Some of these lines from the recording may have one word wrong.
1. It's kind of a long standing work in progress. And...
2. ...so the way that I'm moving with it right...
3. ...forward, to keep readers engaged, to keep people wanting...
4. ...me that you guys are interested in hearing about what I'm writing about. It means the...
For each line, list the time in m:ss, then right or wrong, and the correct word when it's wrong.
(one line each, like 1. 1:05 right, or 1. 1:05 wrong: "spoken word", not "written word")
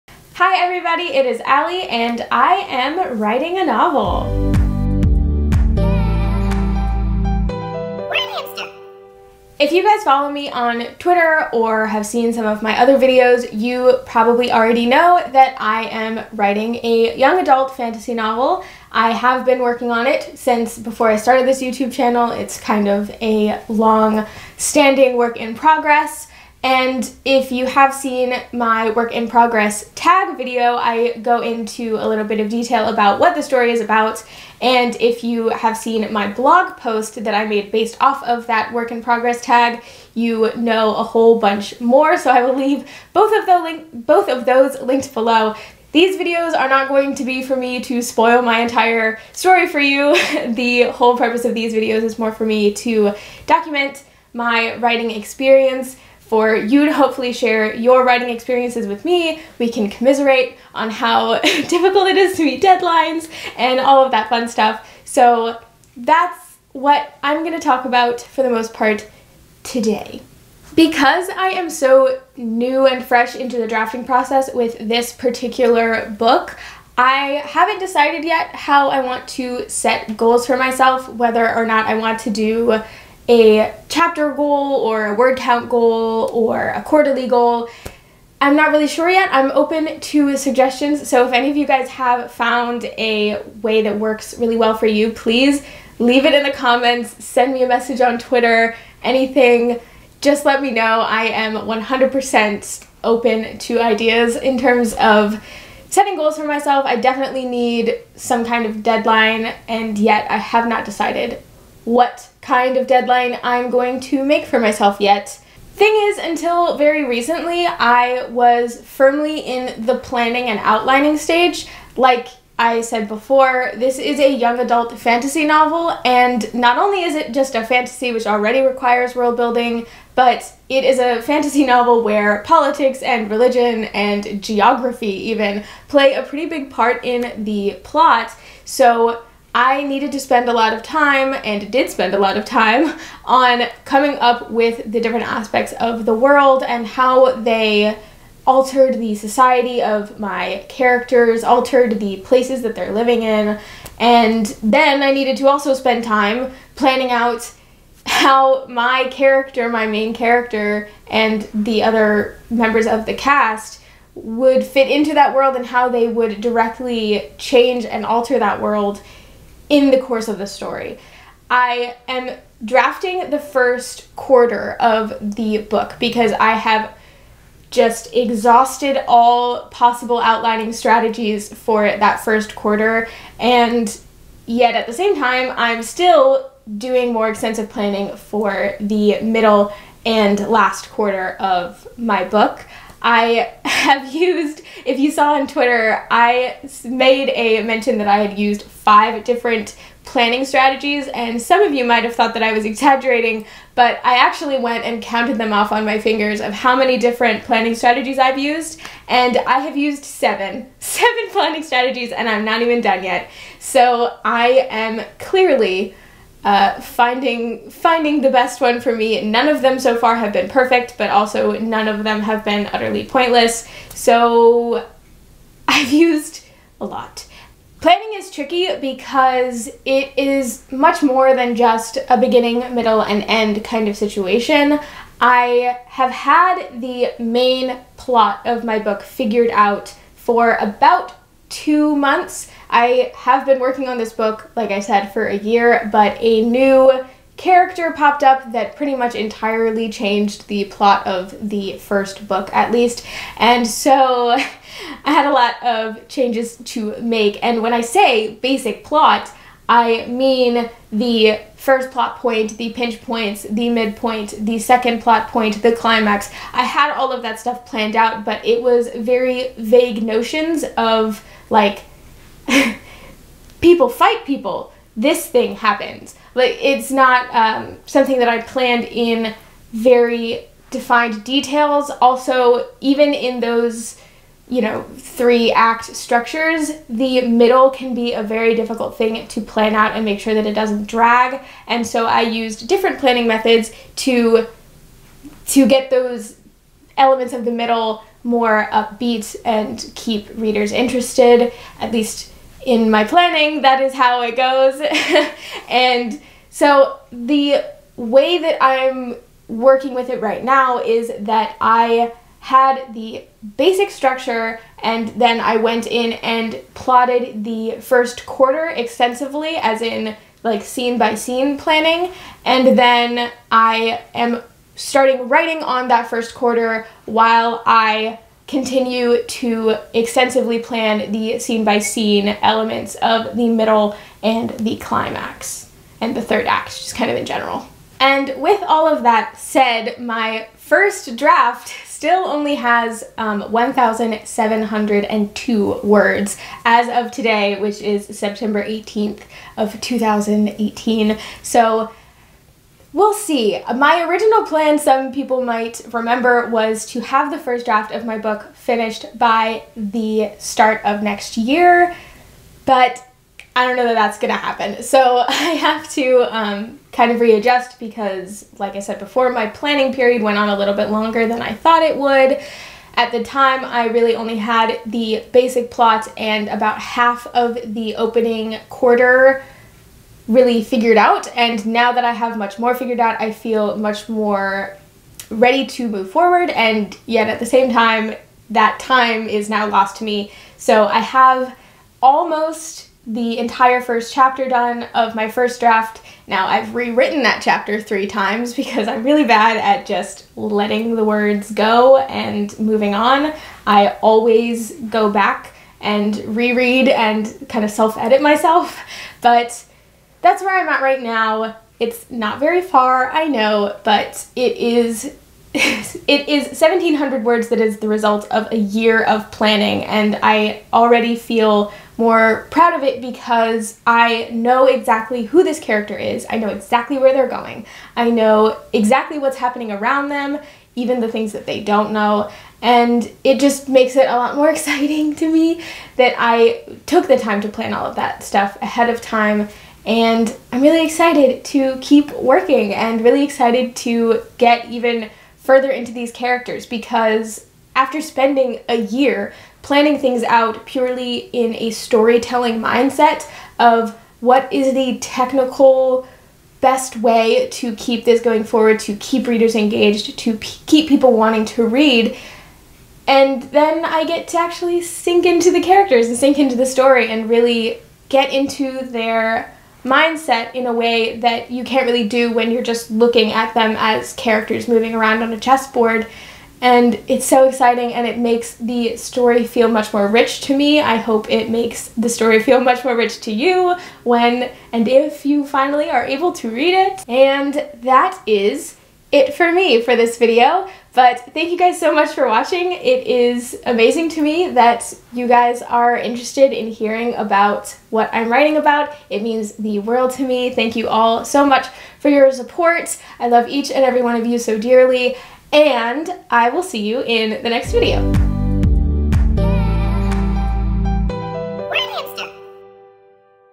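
1. 0:22 right
2. 5:06 wrong: "working", not "moving"
3. 7:38 right
4. 8:14 right.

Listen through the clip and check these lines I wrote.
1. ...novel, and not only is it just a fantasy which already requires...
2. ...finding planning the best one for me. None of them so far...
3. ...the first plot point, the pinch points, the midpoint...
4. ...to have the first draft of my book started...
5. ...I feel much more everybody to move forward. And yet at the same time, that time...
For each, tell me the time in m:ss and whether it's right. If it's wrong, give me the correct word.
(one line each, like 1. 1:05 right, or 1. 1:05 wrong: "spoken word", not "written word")
1. 2:05 right
2. 3:36 wrong: "finding", not "planning"
3. 4:20 right
4. 5:56 wrong: "finished", not "started"
5. 6:23 wrong: "ready", not "everybody".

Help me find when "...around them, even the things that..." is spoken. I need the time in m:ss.
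7:09.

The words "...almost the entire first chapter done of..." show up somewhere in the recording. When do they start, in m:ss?
6:32.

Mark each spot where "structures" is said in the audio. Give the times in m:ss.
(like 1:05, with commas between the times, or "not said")
4:45, 5:13.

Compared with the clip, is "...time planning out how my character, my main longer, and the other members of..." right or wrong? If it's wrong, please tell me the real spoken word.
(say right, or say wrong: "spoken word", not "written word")
wrong: "character", not "longer".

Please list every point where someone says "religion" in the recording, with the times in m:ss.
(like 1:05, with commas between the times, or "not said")
2:13.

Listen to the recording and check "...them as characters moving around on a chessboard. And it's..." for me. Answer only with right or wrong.
right.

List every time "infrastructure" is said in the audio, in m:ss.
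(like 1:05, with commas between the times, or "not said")
not said.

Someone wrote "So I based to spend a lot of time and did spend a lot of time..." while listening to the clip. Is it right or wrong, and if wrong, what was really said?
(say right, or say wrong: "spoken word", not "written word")
wrong: "needed", not "based".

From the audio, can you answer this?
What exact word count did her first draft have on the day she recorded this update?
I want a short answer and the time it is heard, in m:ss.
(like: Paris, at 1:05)
1,702, at 5:43.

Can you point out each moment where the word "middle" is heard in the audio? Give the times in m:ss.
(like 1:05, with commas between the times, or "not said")
3:09, 3:52, 4:47, 4:57, 5:33.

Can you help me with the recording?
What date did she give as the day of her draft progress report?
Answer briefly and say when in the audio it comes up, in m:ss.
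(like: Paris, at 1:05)
September 18th, 2018, at 5:48.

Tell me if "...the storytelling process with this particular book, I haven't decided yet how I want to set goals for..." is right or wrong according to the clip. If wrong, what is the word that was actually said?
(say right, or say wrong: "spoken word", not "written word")
wrong: "drafting", not "storytelling".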